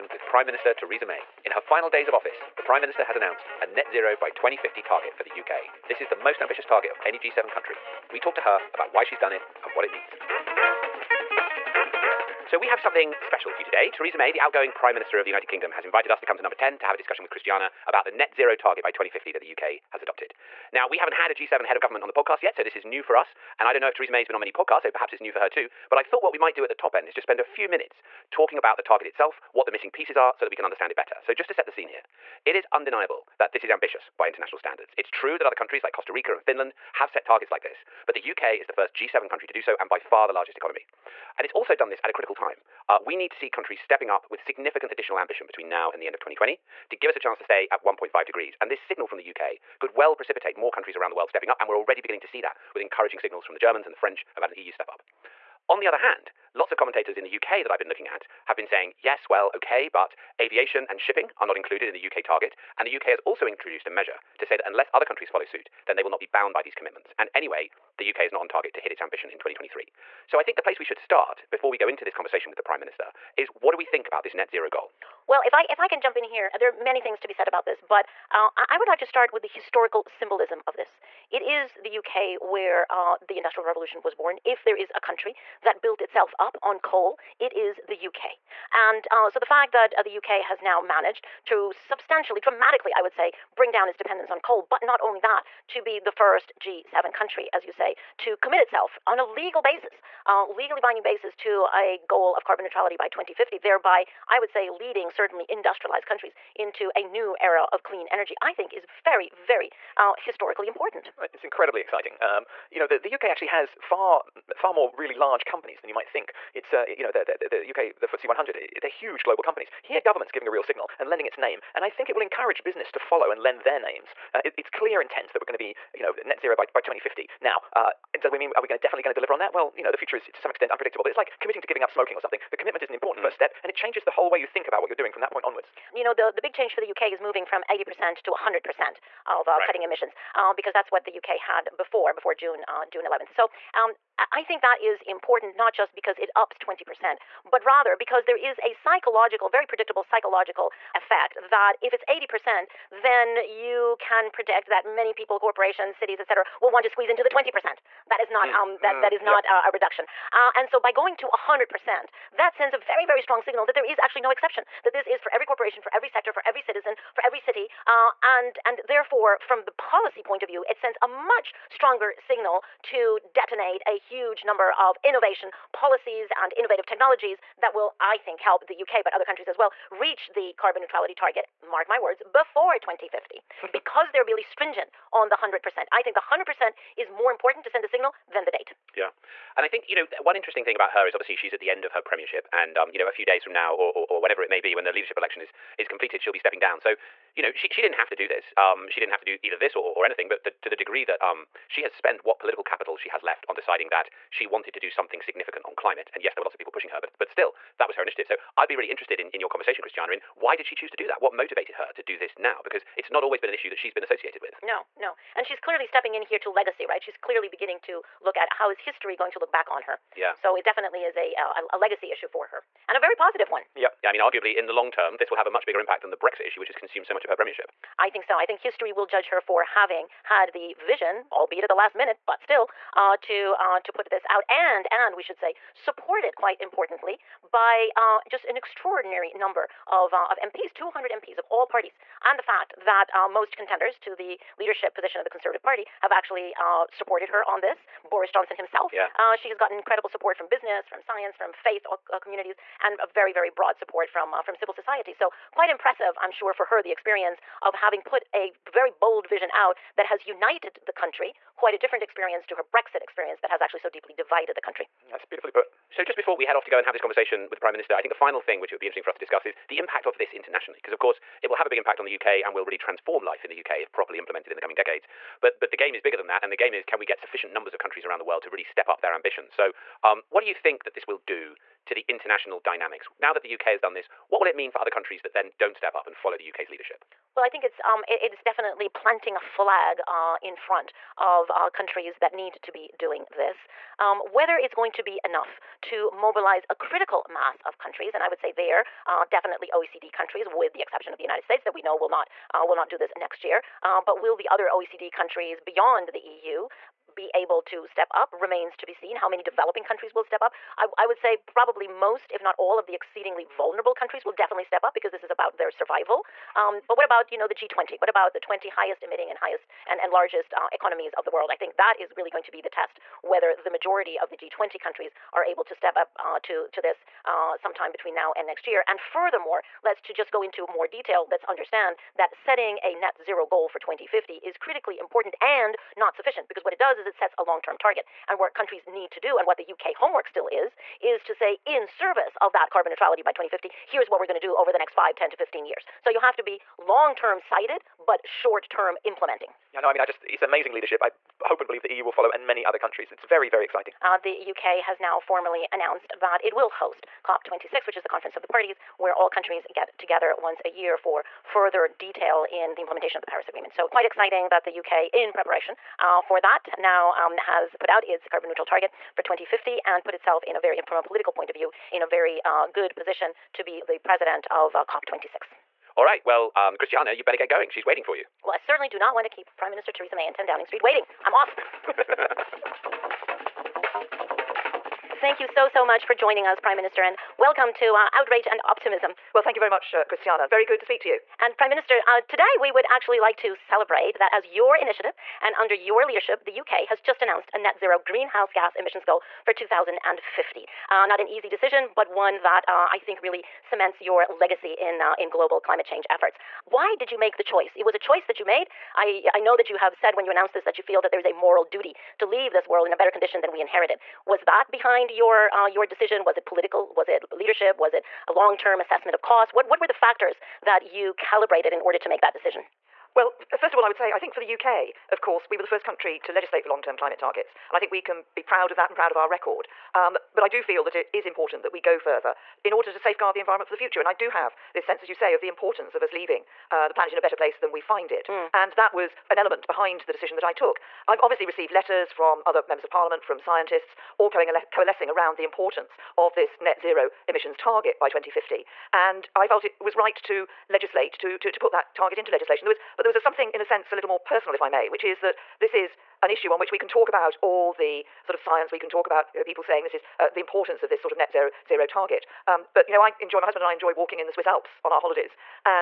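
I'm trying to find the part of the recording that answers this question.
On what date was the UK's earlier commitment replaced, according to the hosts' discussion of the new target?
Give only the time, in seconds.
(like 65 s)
142 s.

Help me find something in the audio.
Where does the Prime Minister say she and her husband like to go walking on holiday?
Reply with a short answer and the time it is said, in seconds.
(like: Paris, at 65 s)
Swiss Alps, at 464 s.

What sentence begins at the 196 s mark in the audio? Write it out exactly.
So, you know, she, she didn't have to do this.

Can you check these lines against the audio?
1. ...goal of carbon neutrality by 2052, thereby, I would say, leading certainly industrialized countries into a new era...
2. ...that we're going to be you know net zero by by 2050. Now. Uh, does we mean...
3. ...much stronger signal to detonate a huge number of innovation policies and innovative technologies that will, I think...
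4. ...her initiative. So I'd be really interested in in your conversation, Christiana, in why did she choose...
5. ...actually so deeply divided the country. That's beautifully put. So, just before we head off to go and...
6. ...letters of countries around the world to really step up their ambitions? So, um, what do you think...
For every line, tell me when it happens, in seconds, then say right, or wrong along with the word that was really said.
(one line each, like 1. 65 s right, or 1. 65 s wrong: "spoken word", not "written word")
1. 102 s wrong: "2050", not "2052"
2. 125 s right
3. 171 s right
4. 207 s right
5. 263 s right
6. 277 s wrong: "numbers", not "letters".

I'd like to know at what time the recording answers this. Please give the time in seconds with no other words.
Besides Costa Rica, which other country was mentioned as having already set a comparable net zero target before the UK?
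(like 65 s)
36 s.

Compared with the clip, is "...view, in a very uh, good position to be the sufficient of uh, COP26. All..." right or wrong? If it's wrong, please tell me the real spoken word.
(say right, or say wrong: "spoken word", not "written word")
wrong: "president", not "sufficient".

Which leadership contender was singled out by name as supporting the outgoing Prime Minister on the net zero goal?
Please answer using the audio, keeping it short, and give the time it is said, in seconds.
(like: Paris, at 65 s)
Boris Johnson, at 248 s.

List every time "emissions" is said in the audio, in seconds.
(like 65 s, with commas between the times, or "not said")
139 s, 398 s, 447 s.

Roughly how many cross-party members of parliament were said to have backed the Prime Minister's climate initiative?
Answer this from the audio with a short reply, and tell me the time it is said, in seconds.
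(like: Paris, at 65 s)
200, at 240 s.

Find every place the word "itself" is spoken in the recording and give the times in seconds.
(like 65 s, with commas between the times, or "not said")
29 s, 85 s, 98 s, 370 s.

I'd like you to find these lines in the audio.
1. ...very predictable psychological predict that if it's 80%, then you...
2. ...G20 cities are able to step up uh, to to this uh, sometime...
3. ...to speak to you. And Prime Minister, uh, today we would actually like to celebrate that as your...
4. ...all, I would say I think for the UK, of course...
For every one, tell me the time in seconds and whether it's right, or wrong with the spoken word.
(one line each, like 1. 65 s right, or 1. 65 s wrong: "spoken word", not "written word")
1. 149 s wrong: "effect", not "predict"
2. 324 s wrong: "countries", not "cities"
3. 390 s right
4. 423 s right.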